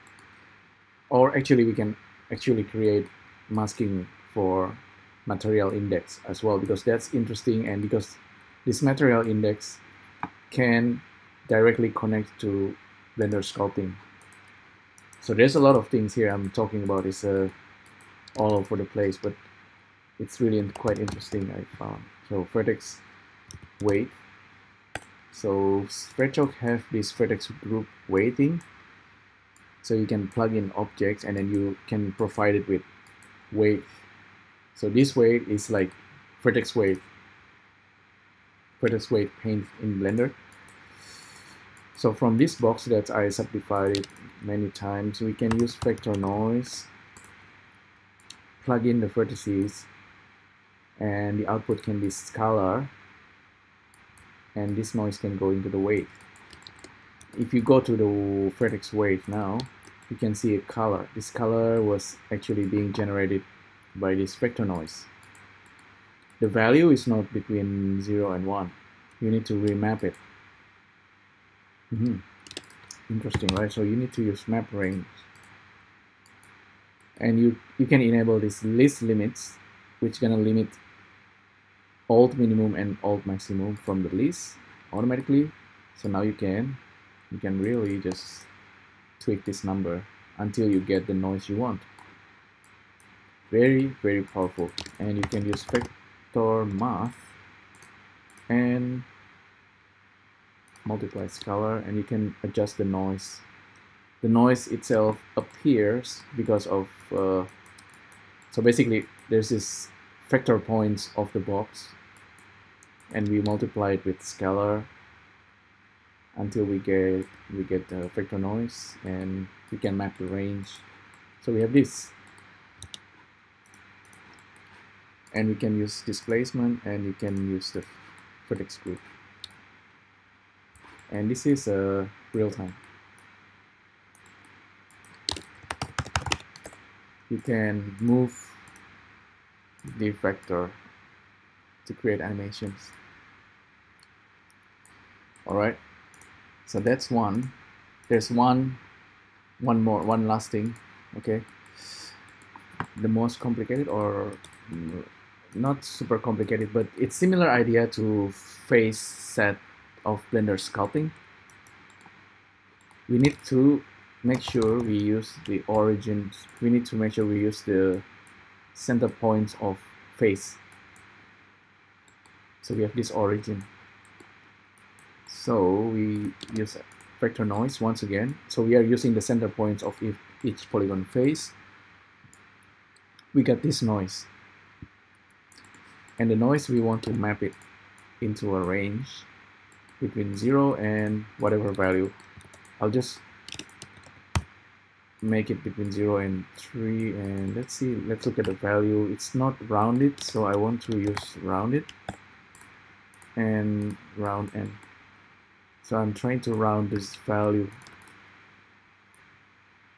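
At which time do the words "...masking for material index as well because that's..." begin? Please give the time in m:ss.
0:03.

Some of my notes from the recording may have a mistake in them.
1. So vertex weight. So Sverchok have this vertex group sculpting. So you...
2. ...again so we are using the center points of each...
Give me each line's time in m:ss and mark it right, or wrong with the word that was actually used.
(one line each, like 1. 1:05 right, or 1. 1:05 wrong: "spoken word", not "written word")
1. 0:22 wrong: "weighting", not "sculpting"
2. 2:58 right.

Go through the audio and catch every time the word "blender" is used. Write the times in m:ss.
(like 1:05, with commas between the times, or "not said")
0:13, 0:39, 2:40.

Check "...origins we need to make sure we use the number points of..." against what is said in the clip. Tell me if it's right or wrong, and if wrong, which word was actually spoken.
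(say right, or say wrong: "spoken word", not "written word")
wrong: "center", not "number".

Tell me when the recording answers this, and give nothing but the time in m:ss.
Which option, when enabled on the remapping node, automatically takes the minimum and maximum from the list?
1:18.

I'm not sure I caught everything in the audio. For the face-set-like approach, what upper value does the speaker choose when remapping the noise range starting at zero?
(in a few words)
3.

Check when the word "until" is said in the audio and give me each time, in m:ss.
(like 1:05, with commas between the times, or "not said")
1:30, 1:56.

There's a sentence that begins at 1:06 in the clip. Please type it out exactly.
The value is not between 0 and 1.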